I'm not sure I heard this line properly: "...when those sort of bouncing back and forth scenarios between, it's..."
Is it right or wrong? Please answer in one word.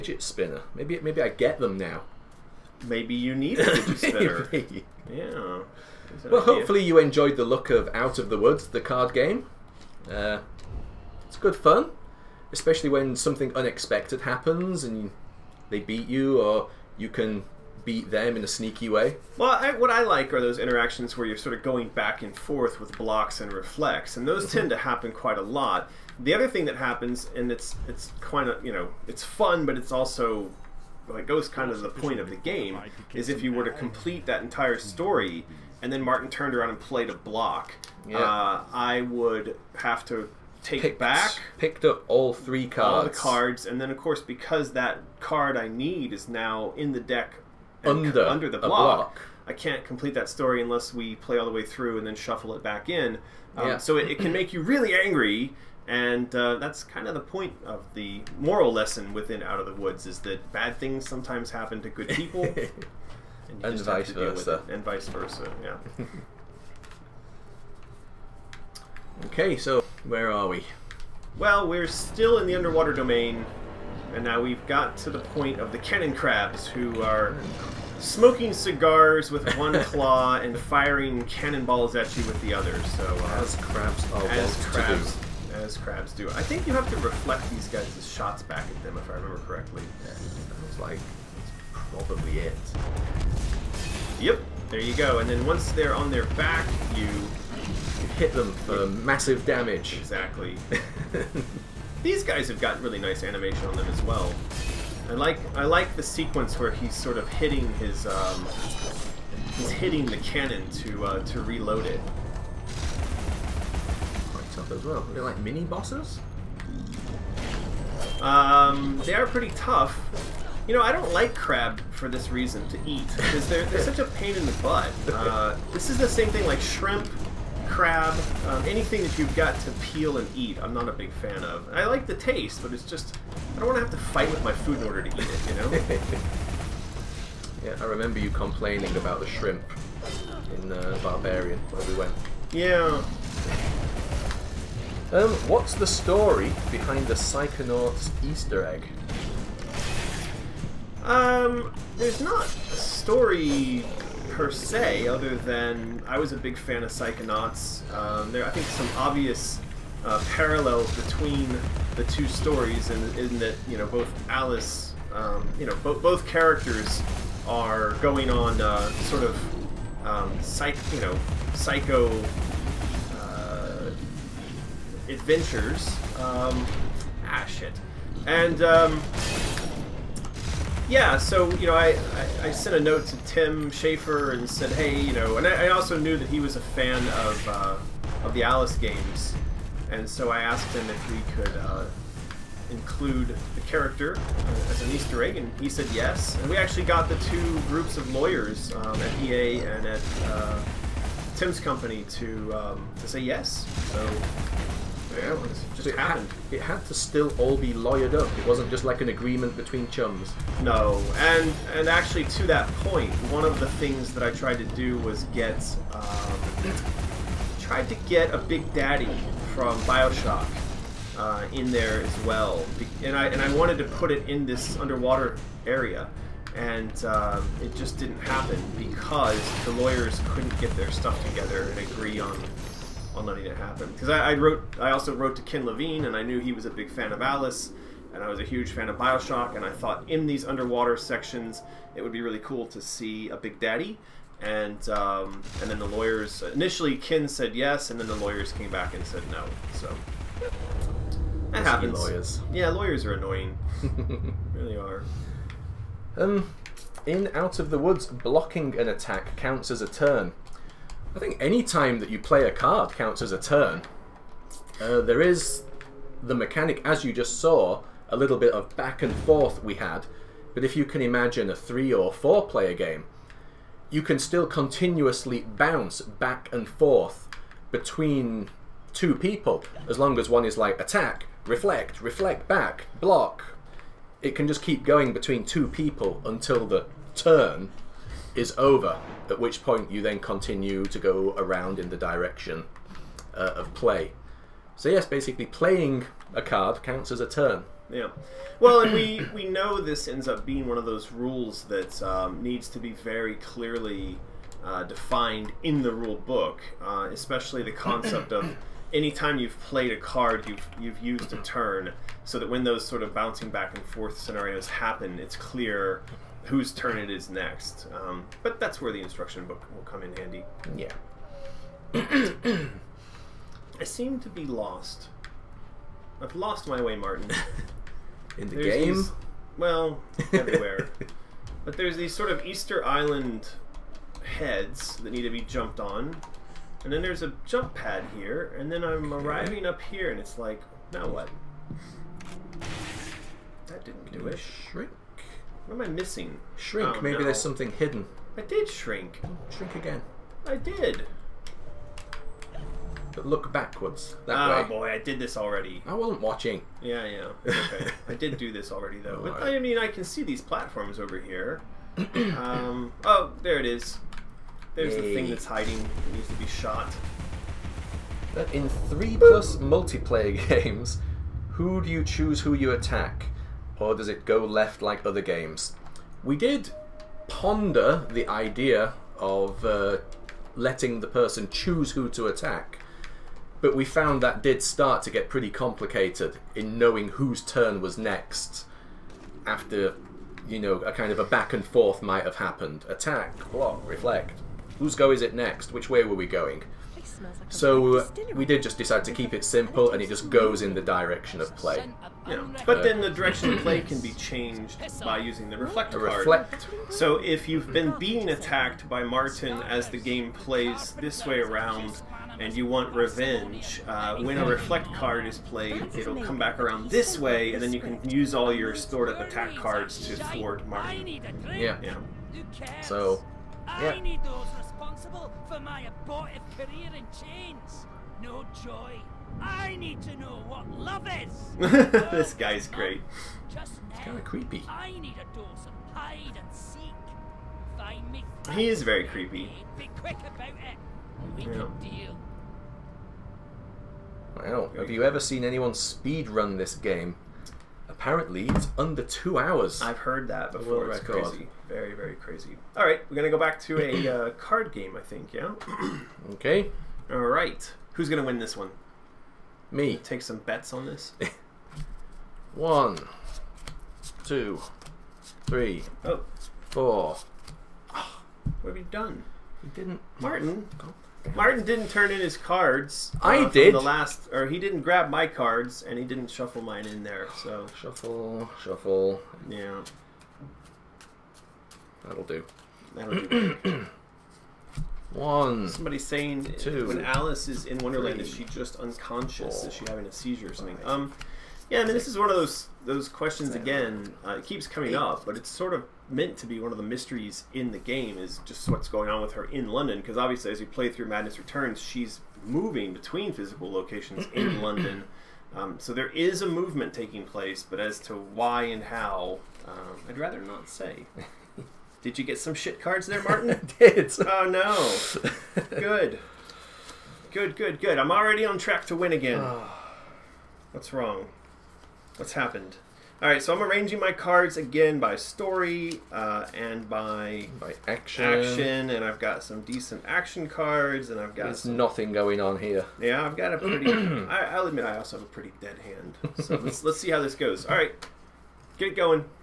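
wrong.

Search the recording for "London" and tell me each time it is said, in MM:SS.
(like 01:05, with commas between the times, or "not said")
08:19, 08:24.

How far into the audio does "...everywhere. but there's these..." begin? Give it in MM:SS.
05:30.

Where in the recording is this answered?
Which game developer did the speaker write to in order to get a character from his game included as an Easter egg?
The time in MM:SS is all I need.
03:03.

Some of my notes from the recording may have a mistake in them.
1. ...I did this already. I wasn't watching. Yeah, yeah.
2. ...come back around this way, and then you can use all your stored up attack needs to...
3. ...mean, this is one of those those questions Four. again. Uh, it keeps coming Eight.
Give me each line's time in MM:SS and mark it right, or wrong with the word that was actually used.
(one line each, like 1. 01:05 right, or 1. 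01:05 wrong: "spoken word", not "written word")
1. 05:54 right
2. 06:56 wrong: "cards", not "needs"
3. 08:11 wrong: "Seven", not "Four".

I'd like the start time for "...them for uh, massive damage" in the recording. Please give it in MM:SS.
01:38.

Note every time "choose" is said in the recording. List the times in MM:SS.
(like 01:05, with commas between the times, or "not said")
06:12, 06:21.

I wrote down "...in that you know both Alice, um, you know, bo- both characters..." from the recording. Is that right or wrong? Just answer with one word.
right.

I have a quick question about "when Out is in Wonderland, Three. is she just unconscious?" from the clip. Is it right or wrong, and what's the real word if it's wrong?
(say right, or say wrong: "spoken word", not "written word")
wrong: "Alice", not "Out".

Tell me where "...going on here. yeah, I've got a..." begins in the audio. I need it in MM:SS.
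08:52.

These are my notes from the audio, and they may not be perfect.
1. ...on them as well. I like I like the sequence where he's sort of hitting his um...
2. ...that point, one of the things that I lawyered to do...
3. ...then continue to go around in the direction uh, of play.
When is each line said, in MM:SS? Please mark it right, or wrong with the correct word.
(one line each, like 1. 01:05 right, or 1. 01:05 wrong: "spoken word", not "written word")
1. 01:43 right
2. 03:32 wrong: "tried", not "lawyered"
3. 04:50 right.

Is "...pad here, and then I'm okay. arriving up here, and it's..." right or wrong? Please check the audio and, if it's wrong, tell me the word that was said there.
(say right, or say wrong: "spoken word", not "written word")
right.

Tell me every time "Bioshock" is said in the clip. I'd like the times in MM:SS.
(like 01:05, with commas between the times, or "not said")
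03:39, 03:58.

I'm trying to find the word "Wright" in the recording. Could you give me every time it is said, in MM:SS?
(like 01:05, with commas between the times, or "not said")
not said.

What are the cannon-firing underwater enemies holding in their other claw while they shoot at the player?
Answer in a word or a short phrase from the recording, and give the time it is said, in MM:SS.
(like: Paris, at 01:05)
Cigars, at 01:18.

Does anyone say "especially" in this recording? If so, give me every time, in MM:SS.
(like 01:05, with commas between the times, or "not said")
00:12, 05:07.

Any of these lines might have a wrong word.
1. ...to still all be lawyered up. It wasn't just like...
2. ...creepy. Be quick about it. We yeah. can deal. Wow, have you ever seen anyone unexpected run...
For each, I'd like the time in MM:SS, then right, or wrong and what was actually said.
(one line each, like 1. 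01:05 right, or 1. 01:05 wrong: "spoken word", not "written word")
1. 03:26 right
2. 07:19 wrong: "speed", not "unexpected".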